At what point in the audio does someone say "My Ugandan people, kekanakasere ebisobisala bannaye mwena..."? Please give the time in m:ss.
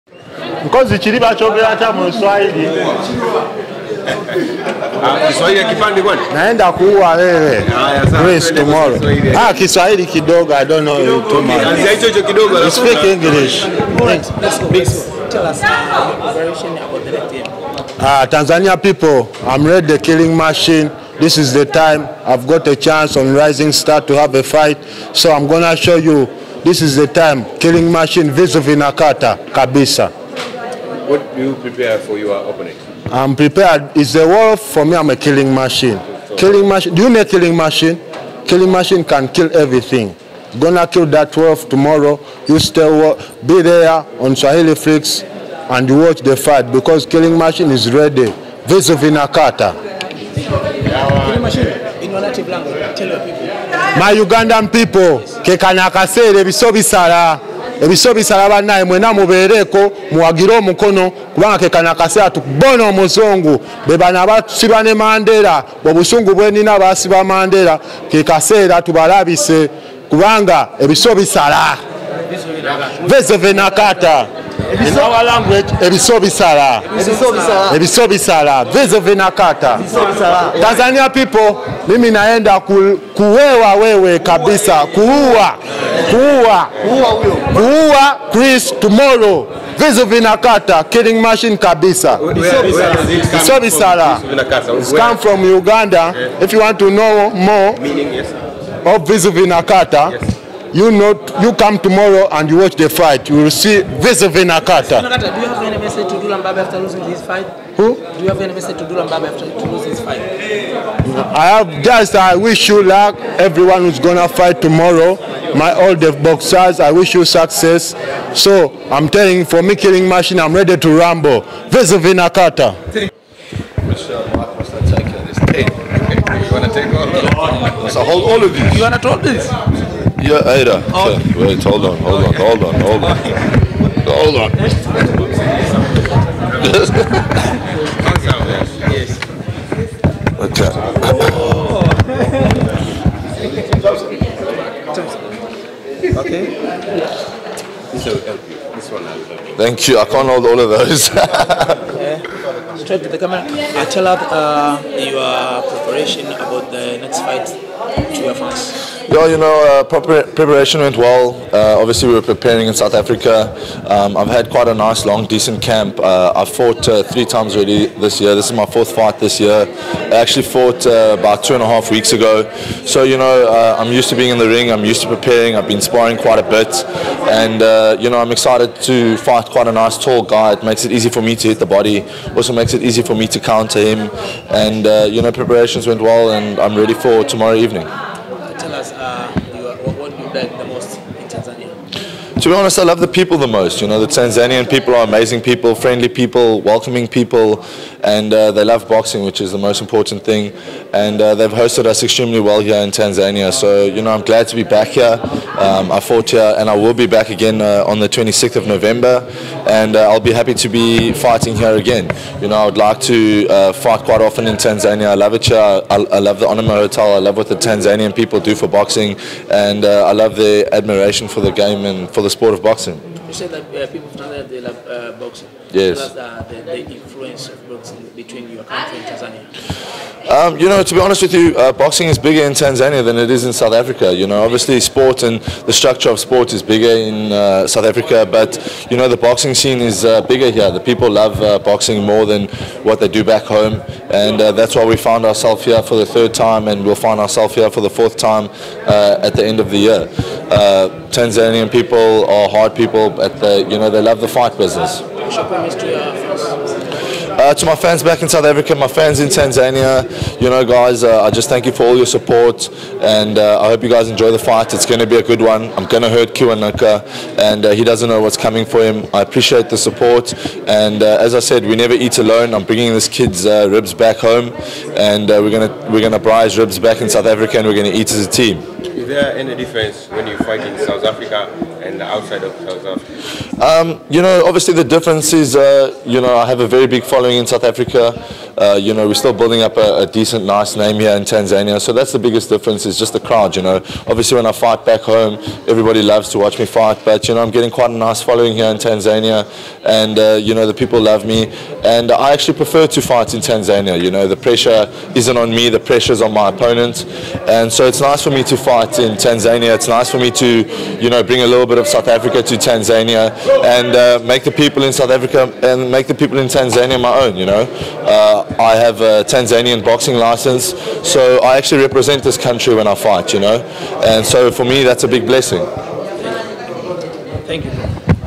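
0:53.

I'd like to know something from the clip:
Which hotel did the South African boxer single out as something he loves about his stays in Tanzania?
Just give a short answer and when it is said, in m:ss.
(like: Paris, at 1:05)
Onomo Hotel, at 3:36.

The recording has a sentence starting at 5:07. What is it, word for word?
And so it's nice for me to fight in Tanzania.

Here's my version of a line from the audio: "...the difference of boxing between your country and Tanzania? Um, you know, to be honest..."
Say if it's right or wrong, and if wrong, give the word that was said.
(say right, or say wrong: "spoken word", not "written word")
wrong: "influence", not "difference".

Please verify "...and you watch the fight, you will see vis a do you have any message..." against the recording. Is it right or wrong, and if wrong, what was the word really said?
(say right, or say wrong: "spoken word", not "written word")
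right.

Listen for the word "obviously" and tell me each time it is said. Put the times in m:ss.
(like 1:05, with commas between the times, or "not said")
2:41, 3:54, 4:44, 4:54.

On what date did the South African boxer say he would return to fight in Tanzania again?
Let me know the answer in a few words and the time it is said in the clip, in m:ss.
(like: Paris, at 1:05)
26 November, at 3:28.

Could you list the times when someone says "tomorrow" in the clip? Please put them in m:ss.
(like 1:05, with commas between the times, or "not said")
0:08, 0:41, 1:28, 1:41, 1:54, 3:07.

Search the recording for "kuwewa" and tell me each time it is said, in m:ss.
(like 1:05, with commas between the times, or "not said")
1:23.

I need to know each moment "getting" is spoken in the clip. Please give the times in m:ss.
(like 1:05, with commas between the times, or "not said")
4:57.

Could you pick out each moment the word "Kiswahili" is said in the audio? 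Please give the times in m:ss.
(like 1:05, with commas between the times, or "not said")
0:05, 0:09.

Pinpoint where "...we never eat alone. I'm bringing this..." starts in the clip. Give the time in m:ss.
4:31.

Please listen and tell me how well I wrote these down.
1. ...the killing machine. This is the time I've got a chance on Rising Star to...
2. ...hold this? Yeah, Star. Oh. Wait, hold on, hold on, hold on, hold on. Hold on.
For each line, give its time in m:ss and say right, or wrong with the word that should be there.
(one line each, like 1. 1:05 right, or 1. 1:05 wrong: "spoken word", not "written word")
1. 0:19 right
2. 2:08 wrong: "Ada", not "Star".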